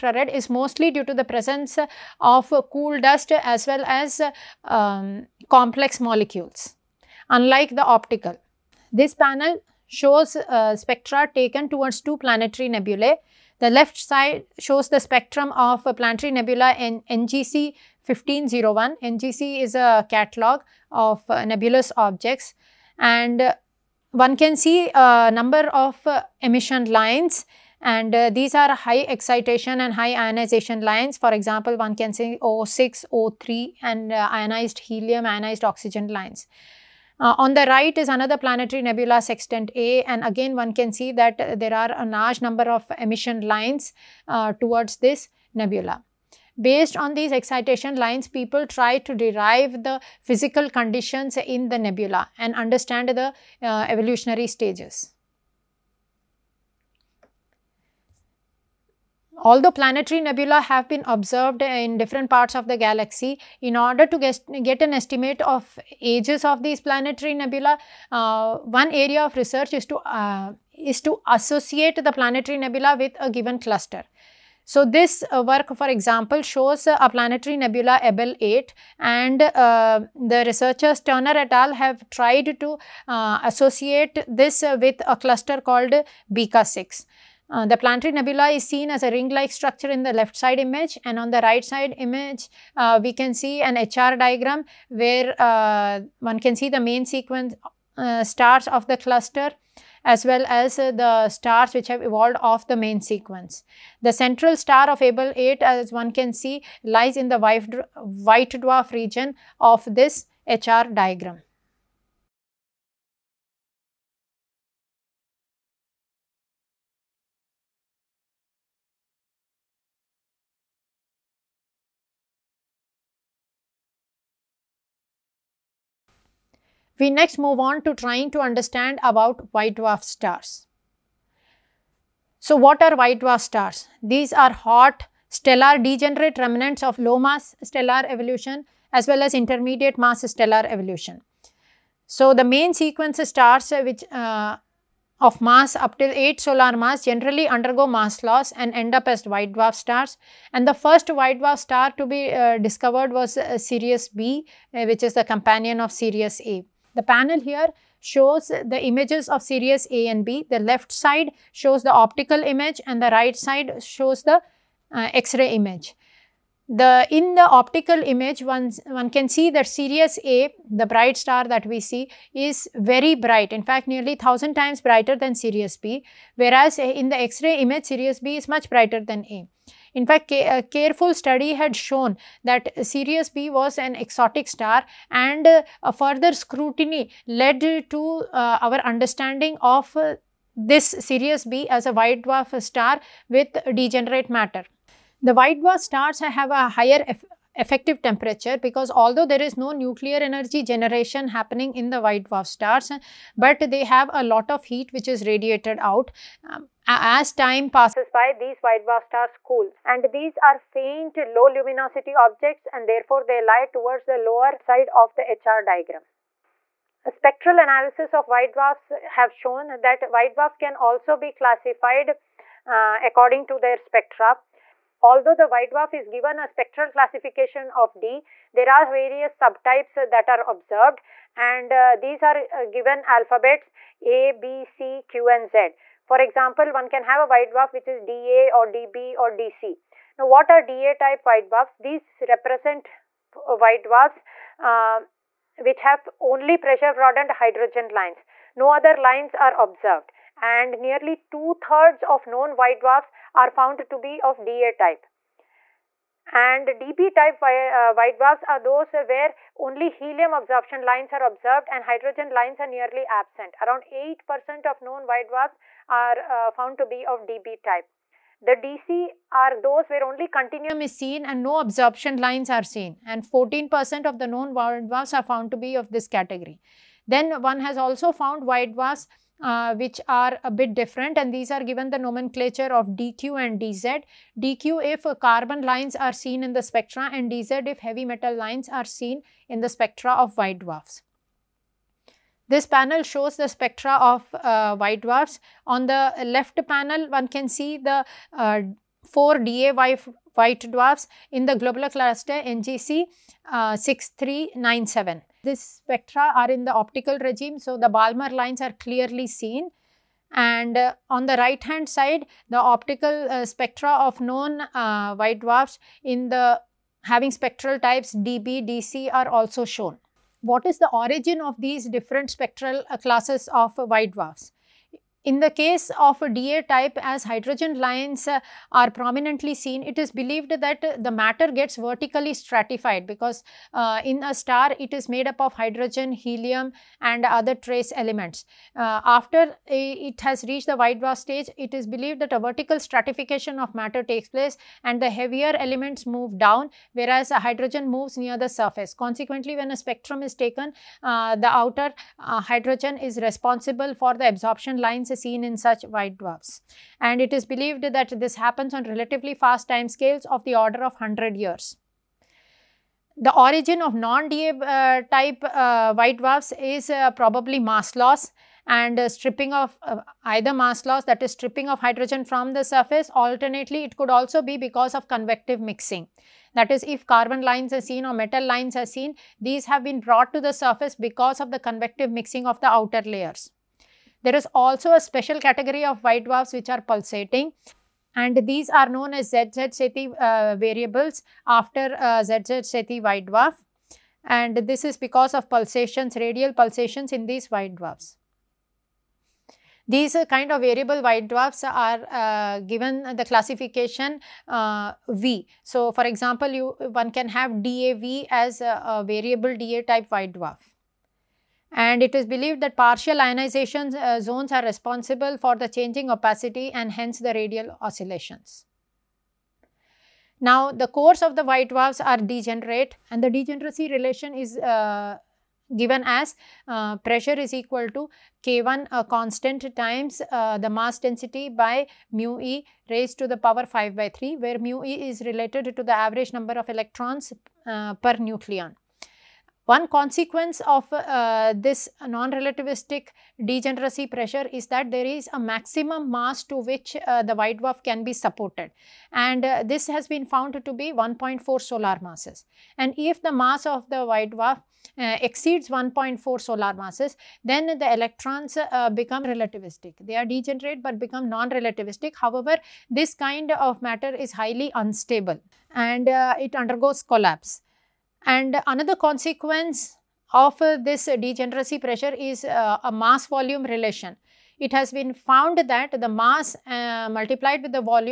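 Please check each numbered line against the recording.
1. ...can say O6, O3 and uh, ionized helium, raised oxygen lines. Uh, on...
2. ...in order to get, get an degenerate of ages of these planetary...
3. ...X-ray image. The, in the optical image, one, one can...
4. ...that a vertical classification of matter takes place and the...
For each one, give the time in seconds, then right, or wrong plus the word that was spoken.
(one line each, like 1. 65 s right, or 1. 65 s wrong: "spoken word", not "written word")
1. 31 s wrong: "ionized", not "raised"
2. 63 s wrong: "estimate", not "degenerate"
3. 165 s right
4. 342 s wrong: "stratification", not "classification".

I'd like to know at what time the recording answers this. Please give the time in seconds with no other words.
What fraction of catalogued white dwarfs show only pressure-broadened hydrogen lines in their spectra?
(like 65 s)
251 s.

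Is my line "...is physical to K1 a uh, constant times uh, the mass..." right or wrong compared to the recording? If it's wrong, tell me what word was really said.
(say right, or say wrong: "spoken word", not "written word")
wrong: "equal", not "physical".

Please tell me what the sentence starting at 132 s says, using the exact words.
So what are white dwarf stars?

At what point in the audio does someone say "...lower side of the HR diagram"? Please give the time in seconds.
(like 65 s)
214 s.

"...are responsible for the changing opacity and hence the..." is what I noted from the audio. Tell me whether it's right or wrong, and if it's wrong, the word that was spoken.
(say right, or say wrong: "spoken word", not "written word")
right.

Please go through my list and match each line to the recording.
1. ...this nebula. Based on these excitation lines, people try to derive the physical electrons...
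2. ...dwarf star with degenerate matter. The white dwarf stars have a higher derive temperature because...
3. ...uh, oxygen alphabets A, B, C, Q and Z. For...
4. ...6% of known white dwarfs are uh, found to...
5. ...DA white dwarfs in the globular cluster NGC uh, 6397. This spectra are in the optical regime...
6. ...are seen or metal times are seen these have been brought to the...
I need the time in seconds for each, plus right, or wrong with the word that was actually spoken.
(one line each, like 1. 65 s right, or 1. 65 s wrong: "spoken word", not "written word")
1. 44 s wrong: "conditions", not "electrons"
2. 192 s wrong: "effective", not "derive"
3. 232 s wrong: "given", not "oxygen"
4. 263 s wrong: "8", not "6"
5. 299 s right
6. 377 s wrong: "lines", not "times".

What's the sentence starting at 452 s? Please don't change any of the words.
And if the mass of the white dwarf uh, exceeds 1.4 solar masses, then the electrons uh, become relativistic.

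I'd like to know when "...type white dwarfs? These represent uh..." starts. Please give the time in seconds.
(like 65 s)
240 s.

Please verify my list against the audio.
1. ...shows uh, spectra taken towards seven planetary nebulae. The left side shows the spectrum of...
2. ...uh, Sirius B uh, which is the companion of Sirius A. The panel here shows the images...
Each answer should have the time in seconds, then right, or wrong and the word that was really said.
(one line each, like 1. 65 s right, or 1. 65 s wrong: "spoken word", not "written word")
1. 9 s wrong: "two", not "seven"
2. 153 s right.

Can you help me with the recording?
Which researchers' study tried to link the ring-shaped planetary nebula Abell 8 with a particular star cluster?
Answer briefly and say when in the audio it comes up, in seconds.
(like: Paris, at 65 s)
Turner et al, at 80 s.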